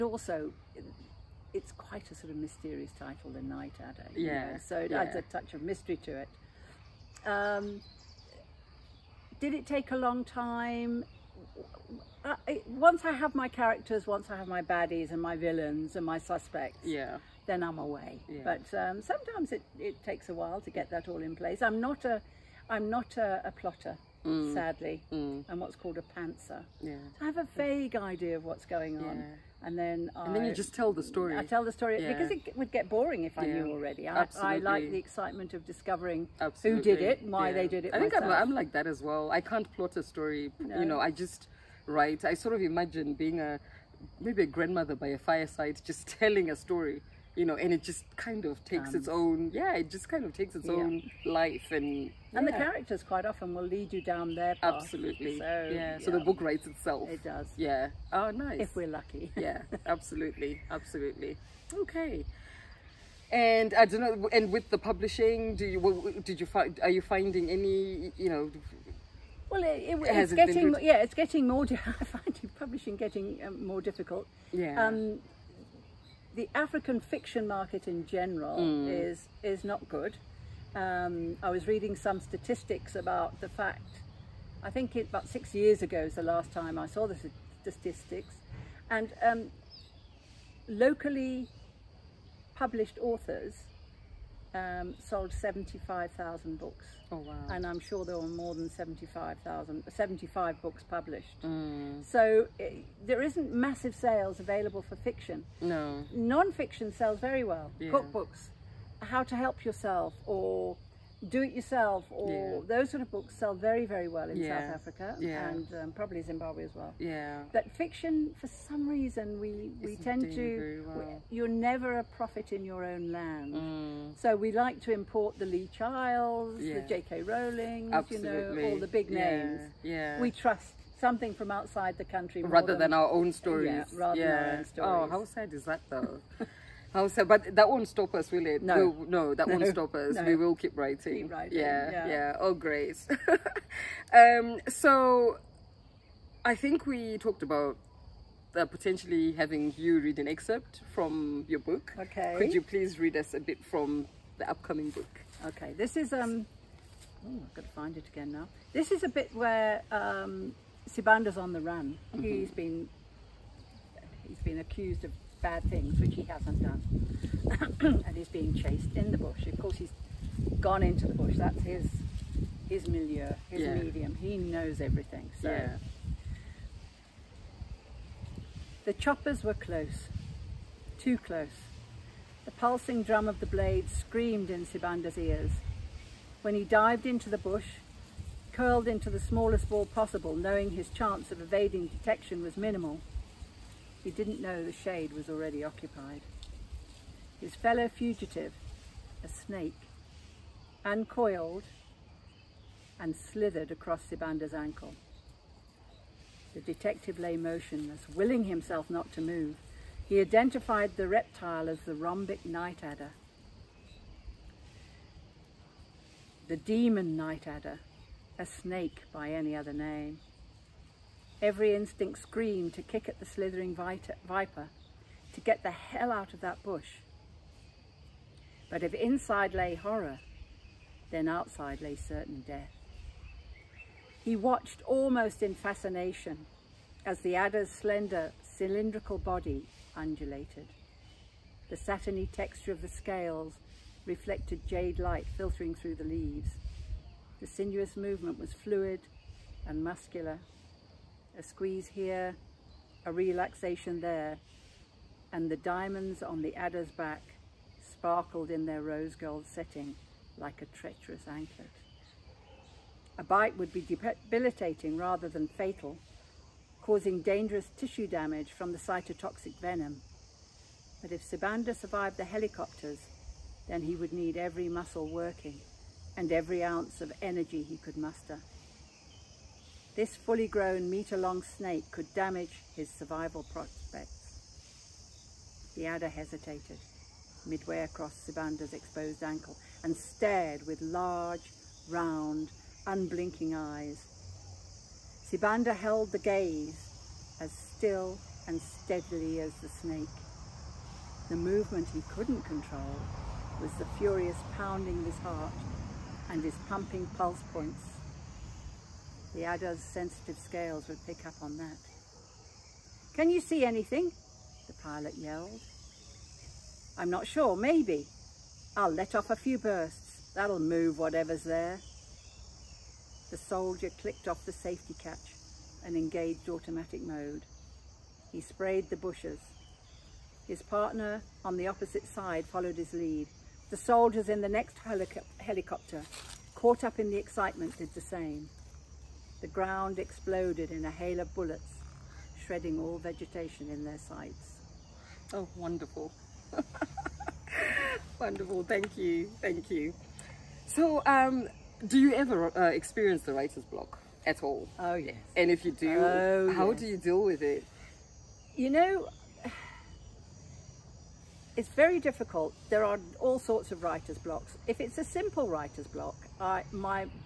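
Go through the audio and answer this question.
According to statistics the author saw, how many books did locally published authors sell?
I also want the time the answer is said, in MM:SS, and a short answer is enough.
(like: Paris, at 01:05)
75,000, at 01:35.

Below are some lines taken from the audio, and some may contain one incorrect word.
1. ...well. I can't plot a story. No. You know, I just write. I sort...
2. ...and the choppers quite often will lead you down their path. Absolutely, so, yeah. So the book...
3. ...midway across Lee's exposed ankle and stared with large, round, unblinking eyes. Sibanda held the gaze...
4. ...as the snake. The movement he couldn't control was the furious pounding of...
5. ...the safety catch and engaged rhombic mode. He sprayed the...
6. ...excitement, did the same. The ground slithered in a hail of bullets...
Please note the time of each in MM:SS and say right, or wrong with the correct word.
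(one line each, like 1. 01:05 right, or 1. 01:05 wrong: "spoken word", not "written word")
1. 00:39 right
2. 00:52 wrong: "characters", not "choppers"
3. 04:47 wrong: "Sibanda", not "Lee"
4. 04:59 right
5. 05:24 wrong: "automatic", not "rhombic"
6. 05:37 wrong: "exploded", not "slithered".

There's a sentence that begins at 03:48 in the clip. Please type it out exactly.
But if inside lay horror, then outside lay certain death.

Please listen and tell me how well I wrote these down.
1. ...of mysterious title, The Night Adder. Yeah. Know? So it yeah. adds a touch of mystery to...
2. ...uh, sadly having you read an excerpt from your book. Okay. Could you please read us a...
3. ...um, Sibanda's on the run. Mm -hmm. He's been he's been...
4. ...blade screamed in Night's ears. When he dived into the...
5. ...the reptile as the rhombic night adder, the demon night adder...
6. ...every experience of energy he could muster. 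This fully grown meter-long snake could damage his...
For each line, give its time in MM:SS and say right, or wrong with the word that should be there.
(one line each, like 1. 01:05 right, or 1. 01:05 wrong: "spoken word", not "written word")
1. 00:02 right
2. 02:28 wrong: "potentially", not "sadly"
3. 02:39 right
4. 03:03 wrong: "Sibanda", not "Night"
5. 03:30 right
6. 04:36 wrong: "ounce", not "experience".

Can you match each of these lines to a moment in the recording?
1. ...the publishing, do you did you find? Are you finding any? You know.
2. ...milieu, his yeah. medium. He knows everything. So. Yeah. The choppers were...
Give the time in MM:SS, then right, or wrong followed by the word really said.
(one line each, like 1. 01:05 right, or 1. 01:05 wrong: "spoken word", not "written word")
1. 01:04 right
2. 02:52 right.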